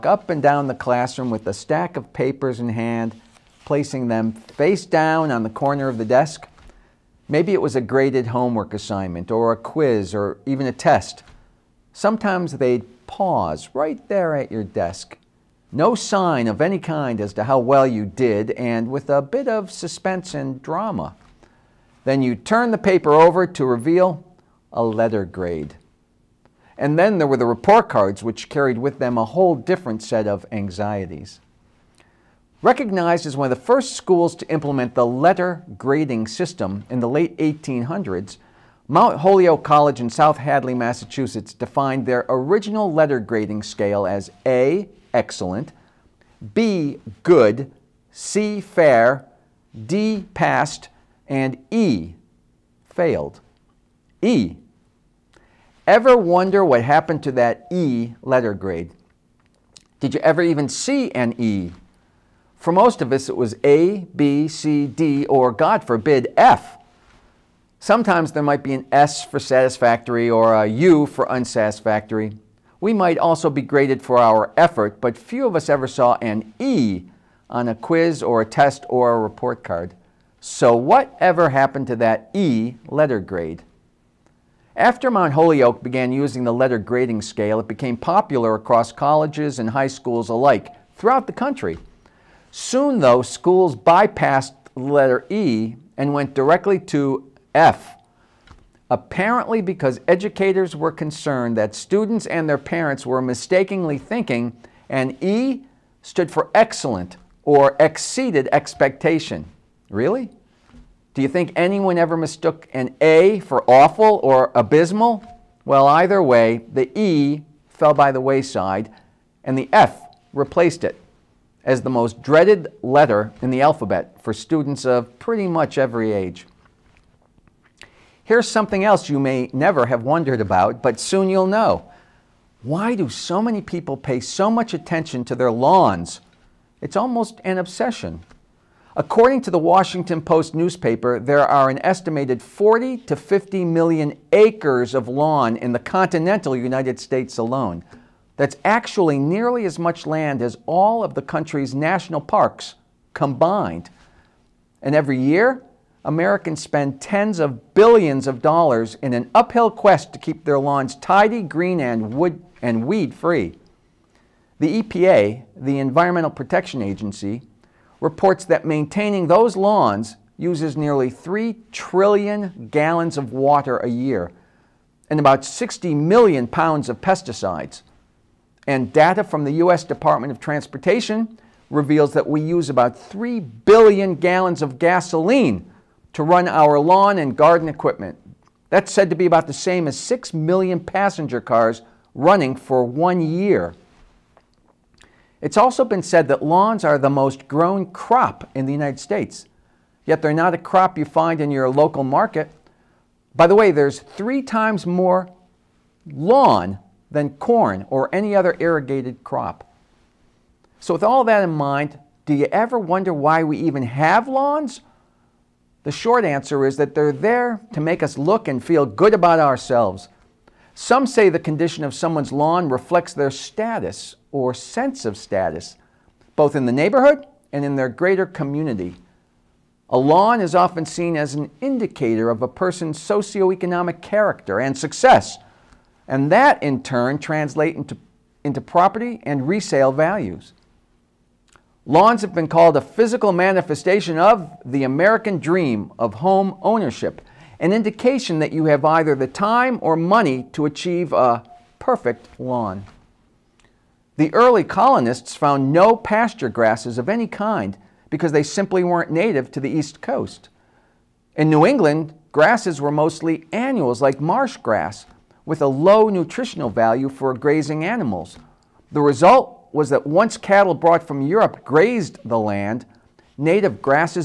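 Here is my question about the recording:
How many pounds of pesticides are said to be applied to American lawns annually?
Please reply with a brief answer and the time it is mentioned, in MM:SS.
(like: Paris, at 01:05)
60 million pounds, at 02:55.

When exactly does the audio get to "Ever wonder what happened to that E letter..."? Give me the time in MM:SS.
00:55.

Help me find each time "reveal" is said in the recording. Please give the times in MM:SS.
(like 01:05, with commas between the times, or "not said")
00:23, 03:01.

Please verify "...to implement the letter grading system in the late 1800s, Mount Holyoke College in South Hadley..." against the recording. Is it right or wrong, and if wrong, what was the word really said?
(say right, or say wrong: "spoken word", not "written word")
right.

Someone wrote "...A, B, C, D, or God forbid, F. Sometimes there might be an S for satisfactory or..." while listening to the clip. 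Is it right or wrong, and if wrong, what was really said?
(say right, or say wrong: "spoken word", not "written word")
right.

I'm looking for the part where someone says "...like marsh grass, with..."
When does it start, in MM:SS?
04:24.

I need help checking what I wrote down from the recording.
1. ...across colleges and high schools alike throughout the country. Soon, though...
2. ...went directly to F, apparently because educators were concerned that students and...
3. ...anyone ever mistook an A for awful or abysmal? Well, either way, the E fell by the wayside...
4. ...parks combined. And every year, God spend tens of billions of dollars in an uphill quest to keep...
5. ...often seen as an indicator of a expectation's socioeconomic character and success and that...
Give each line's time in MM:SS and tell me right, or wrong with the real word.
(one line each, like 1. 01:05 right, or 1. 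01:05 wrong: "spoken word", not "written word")
1. 01:28 right
2. 01:36 right
3. 01:51 right
4. 02:32 wrong: "Americans", not "God"
5. 03:50 wrong: "person", not "expectation".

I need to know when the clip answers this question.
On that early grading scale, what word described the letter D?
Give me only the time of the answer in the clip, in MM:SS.
00:50.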